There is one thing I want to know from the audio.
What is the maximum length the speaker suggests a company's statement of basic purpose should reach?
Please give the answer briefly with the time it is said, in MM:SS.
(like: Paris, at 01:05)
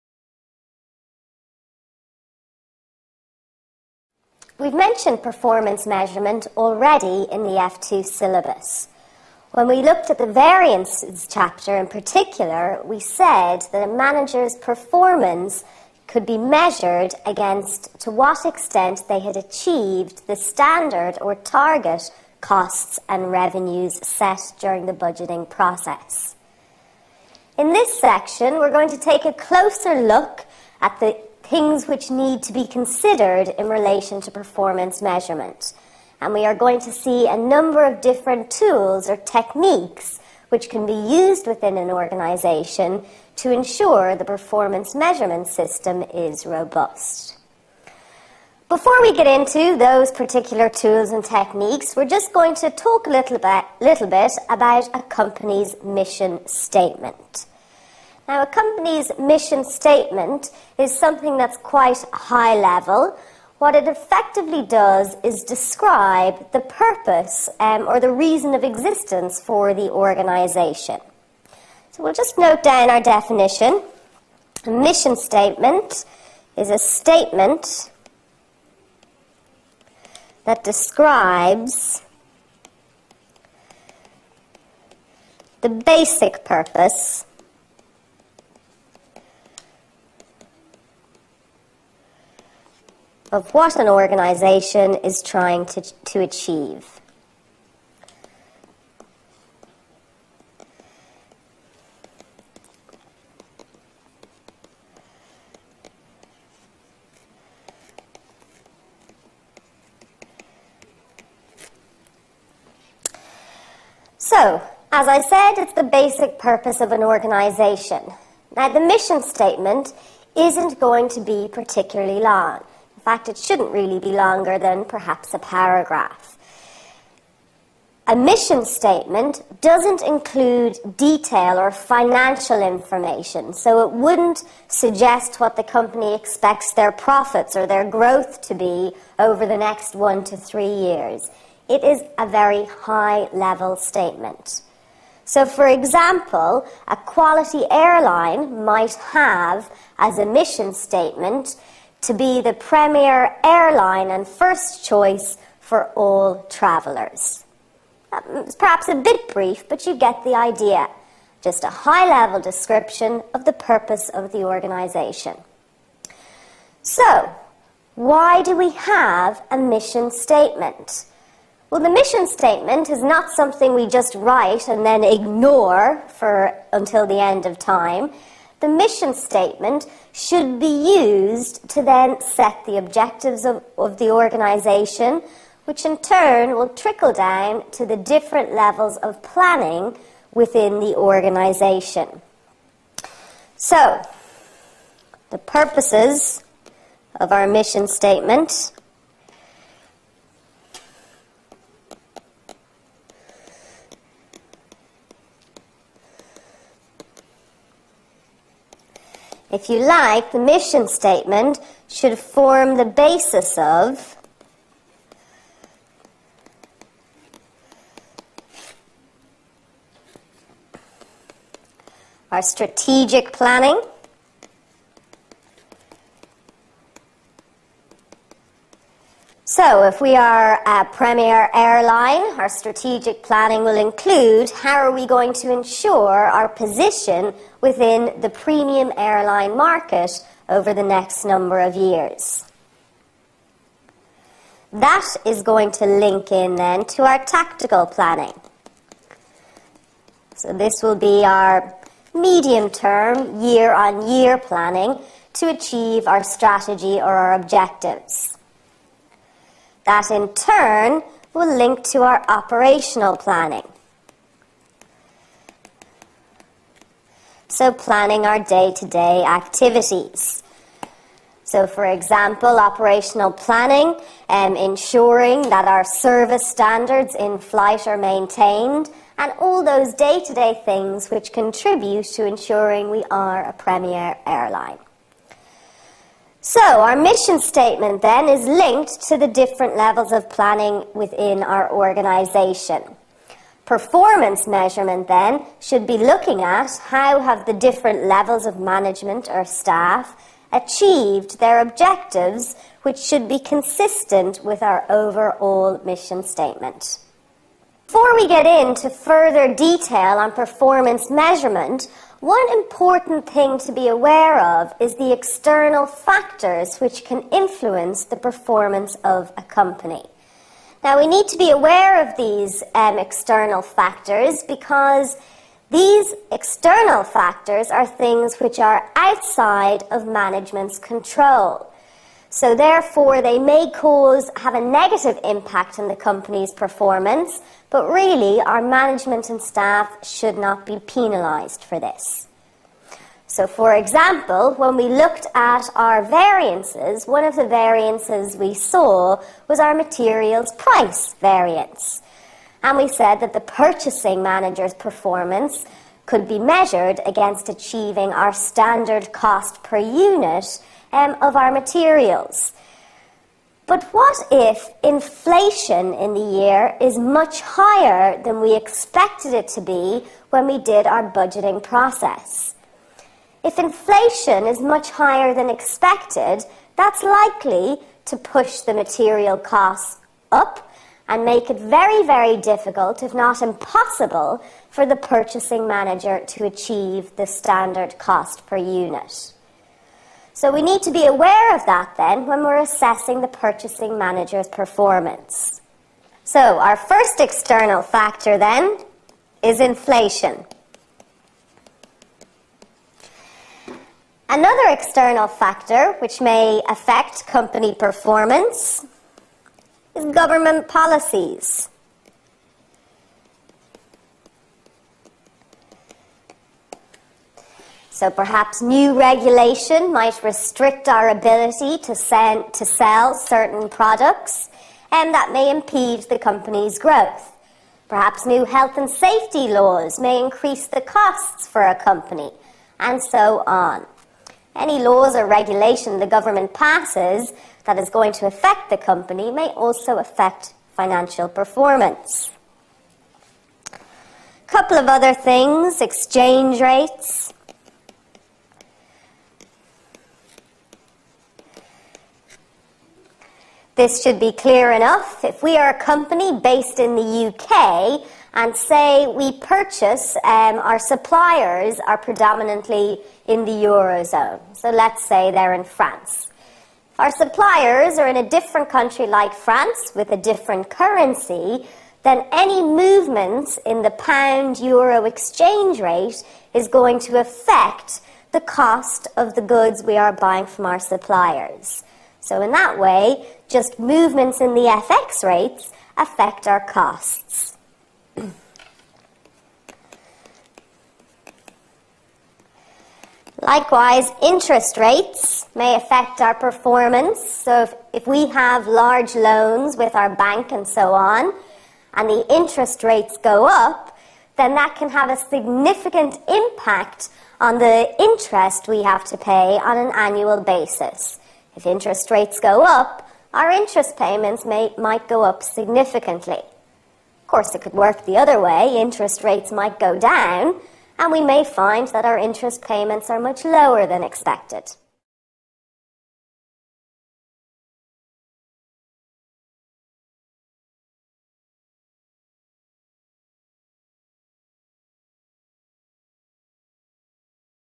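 a paragraph, at 02:05.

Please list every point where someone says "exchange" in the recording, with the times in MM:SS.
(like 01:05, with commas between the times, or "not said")
07:25, 07:55.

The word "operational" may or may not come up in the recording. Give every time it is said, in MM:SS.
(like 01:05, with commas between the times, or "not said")
04:22, 04:32.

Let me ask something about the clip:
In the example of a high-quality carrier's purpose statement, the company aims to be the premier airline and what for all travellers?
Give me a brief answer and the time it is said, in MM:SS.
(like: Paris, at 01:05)
first choice, at 02:34.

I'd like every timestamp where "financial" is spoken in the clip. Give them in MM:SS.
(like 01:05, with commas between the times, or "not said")
02:11, 07:20.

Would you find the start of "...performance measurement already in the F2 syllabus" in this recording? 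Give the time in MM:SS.
00:05.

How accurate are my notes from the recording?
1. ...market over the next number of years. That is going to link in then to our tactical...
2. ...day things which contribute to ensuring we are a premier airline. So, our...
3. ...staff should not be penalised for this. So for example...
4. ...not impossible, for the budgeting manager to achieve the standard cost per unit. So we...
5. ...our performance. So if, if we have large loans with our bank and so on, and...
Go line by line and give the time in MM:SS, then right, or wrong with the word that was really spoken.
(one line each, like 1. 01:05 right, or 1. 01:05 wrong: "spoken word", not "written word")
1. 03:59 right
2. 04:40 right
3. 05:39 right
4. 06:23 wrong: "purchasing", not "budgeting"
5. 08:16 right.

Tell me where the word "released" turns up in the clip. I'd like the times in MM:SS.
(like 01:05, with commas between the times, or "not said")
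not said.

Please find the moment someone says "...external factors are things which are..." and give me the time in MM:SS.
05:26.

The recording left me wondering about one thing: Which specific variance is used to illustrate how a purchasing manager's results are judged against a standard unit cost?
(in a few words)
materials price variance.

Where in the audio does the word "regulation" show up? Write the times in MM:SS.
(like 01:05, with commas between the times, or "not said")
06:58, 07:15.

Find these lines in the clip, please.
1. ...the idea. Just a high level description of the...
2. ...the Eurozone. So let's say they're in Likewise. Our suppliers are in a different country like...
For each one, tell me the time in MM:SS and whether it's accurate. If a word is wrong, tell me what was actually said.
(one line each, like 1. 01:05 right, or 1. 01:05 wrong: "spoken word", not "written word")
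1. 02:40 right
2. 07:43 wrong: "France", not "Likewise".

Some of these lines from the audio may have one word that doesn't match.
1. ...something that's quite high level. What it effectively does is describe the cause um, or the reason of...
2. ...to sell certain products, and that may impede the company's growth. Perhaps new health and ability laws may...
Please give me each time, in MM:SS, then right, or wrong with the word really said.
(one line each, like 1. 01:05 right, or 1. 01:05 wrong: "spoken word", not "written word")
1. 01:00 wrong: "purpose", not "cause"
2. 07:02 wrong: "safety", not "ability".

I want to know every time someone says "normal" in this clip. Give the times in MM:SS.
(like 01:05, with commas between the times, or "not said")
not said.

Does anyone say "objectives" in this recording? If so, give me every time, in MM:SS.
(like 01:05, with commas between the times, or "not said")
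03:02, 04:17, 05:01.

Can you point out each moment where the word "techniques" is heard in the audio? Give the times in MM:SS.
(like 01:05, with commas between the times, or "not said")
00:39, 00:51.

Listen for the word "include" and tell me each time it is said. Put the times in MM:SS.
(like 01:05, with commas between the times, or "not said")
02:10, 03:53.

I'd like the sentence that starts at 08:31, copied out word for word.
If interest rates go up, our interest payments may, might go up significantly.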